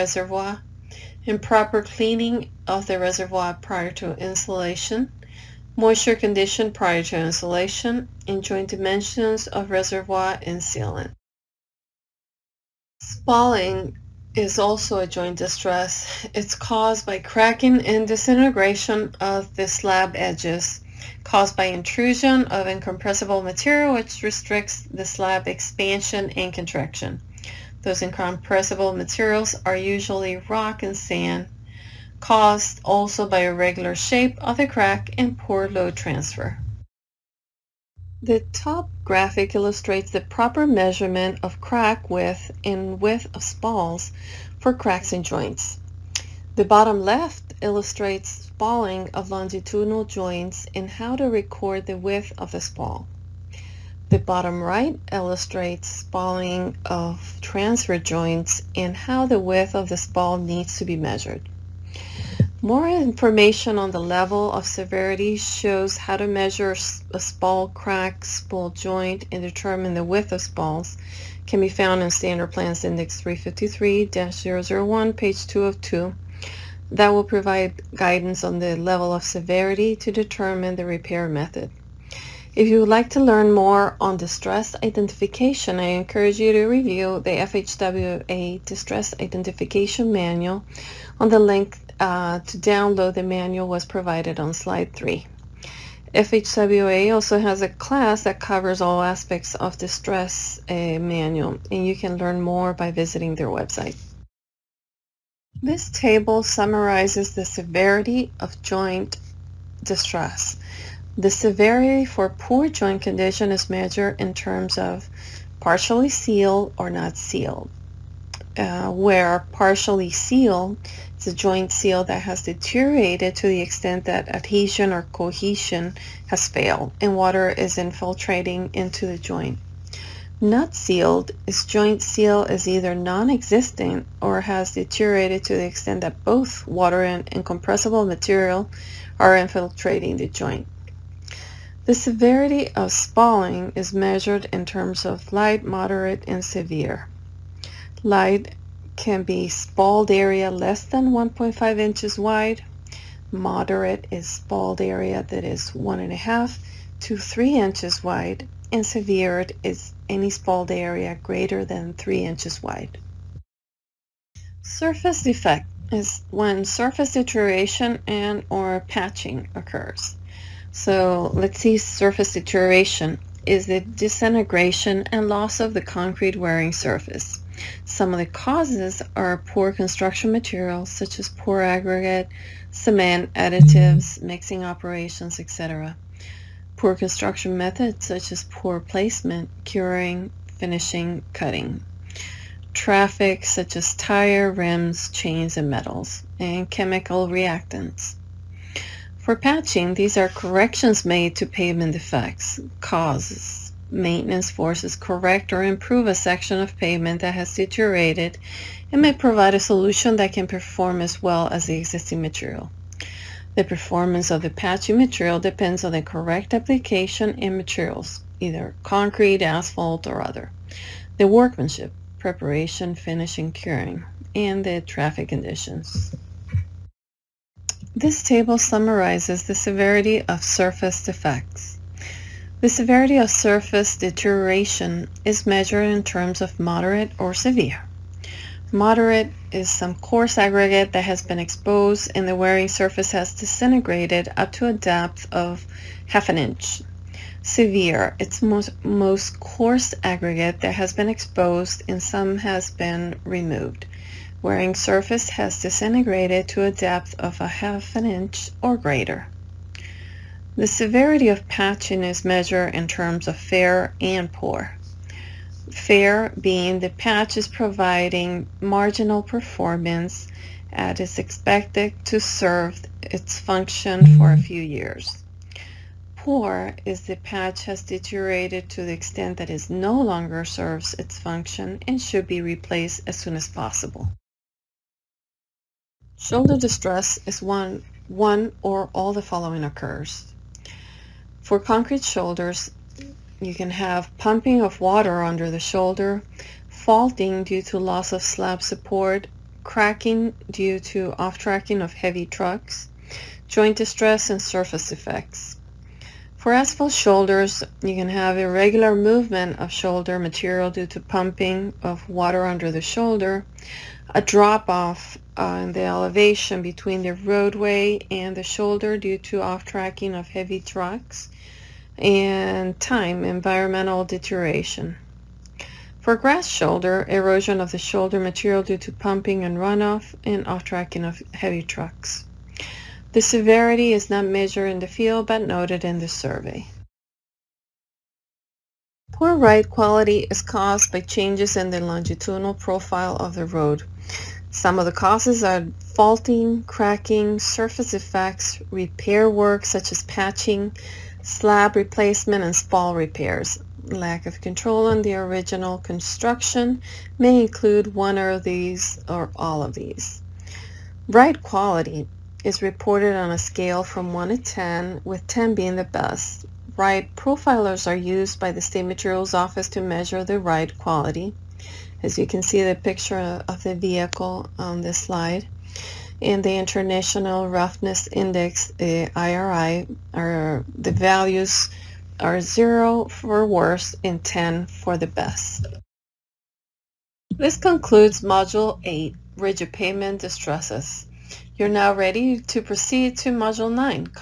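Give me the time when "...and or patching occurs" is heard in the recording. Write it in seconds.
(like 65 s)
168 s.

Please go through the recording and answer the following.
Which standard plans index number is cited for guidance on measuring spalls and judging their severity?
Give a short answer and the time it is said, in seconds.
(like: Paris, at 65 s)
353-001, at 72 s.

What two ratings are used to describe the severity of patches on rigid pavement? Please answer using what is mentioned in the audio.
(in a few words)
fair and poor.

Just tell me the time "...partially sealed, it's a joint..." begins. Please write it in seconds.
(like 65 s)
119 s.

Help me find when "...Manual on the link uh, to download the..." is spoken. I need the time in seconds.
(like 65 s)
90 s.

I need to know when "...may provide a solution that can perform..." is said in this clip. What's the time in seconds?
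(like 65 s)
209 s.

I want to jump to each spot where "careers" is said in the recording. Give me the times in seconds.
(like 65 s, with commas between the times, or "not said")
not said.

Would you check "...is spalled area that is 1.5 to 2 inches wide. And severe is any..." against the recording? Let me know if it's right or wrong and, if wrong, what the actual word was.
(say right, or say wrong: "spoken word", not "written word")
wrong: "3", not "2".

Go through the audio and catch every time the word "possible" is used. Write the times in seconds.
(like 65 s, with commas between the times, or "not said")
283 s.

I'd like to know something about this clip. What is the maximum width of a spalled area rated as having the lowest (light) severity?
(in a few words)
1.5 inches.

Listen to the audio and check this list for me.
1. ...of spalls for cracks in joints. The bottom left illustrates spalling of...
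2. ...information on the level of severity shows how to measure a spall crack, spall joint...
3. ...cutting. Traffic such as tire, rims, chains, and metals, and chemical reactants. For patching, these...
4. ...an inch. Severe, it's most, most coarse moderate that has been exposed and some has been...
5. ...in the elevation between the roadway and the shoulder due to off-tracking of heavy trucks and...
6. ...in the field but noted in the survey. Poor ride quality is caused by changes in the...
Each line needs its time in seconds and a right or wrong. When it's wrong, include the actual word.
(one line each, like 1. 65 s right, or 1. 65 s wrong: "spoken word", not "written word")
1. 43 s right
2. 62 s right
3. 191 s right
4. 246 s wrong: "aggregate", not "moderate"
5. 315 s right
6. 334 s right.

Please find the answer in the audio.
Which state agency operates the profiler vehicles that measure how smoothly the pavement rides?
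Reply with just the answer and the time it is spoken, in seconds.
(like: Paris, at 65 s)
State Materials Office, at 368 s.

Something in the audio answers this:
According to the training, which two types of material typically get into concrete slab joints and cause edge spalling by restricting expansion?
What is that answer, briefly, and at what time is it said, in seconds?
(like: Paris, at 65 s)
rock and sand, at 30 s.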